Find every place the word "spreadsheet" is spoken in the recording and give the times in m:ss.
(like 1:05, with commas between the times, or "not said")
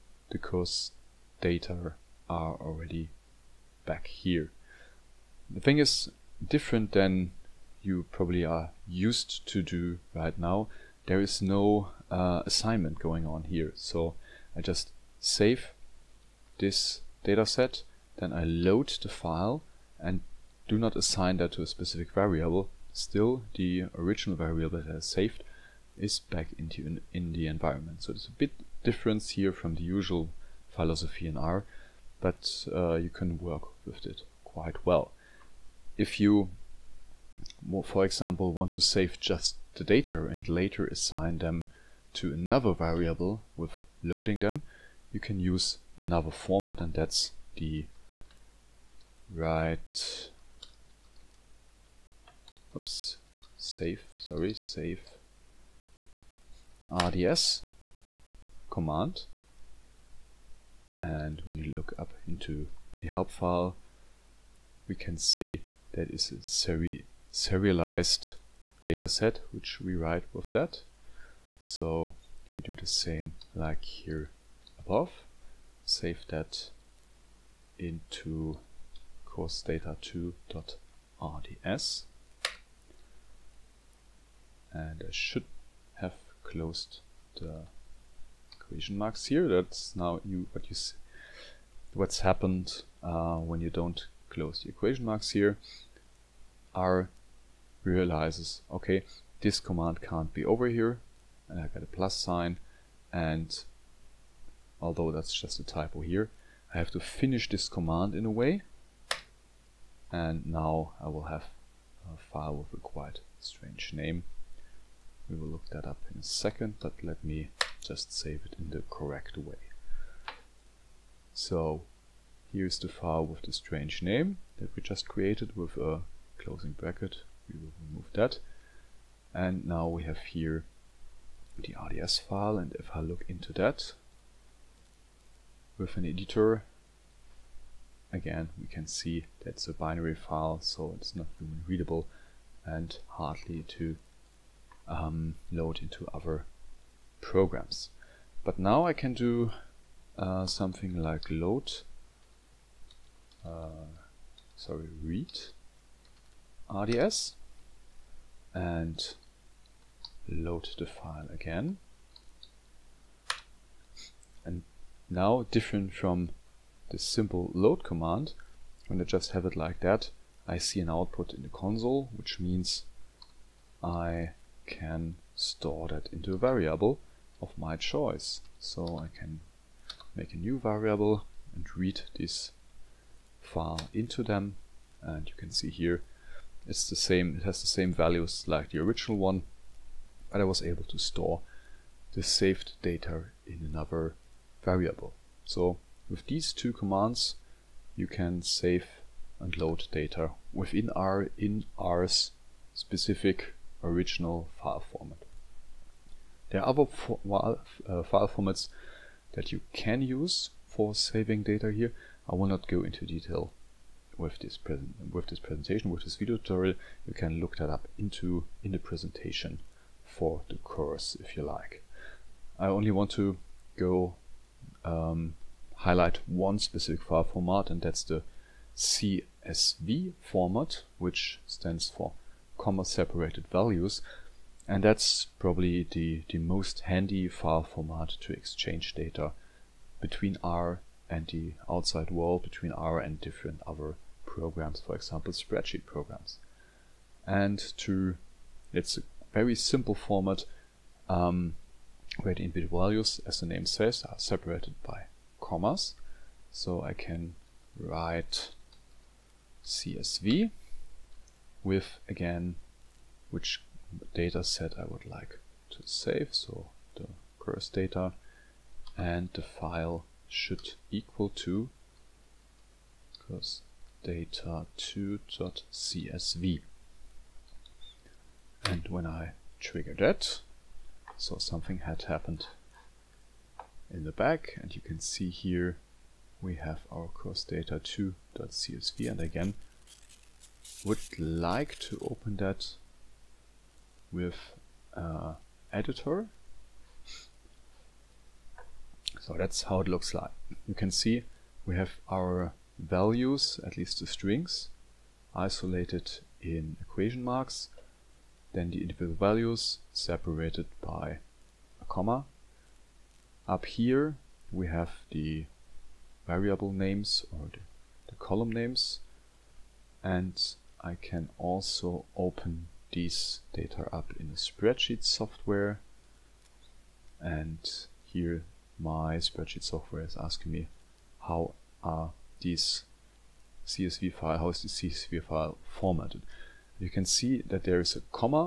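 4:05, 5:24, 5:29.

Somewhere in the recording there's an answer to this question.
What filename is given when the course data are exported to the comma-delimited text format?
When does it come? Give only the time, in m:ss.
4:33.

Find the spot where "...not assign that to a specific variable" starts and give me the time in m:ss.
0:20.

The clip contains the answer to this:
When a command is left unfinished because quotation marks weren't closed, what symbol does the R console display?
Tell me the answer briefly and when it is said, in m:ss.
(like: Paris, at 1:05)
plus sign, at 1:41.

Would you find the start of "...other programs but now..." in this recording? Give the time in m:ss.
2:26.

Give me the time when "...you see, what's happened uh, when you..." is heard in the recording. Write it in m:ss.
1:30.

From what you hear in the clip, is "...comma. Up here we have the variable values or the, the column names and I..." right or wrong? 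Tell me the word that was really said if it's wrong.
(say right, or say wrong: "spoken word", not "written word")
wrong: "names", not "values".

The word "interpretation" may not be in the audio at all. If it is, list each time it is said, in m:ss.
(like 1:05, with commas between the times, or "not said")
not said.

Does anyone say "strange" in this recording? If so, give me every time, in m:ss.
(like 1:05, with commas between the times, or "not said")
1:53, 2:03.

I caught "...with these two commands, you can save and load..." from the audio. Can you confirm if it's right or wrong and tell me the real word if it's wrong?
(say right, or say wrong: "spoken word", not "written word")
right.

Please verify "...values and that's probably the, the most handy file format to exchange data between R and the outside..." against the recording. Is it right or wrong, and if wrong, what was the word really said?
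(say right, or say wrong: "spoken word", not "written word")
right.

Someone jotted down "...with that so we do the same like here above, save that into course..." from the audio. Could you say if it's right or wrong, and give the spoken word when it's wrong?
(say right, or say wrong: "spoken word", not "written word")
right.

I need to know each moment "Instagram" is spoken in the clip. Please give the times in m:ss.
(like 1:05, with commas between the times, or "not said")
not said.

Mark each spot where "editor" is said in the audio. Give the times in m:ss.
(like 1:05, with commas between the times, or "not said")
2:16, 4:55.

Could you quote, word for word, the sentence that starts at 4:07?
And to it's a very simple format um, where the input values, as the name says, are separated by commas.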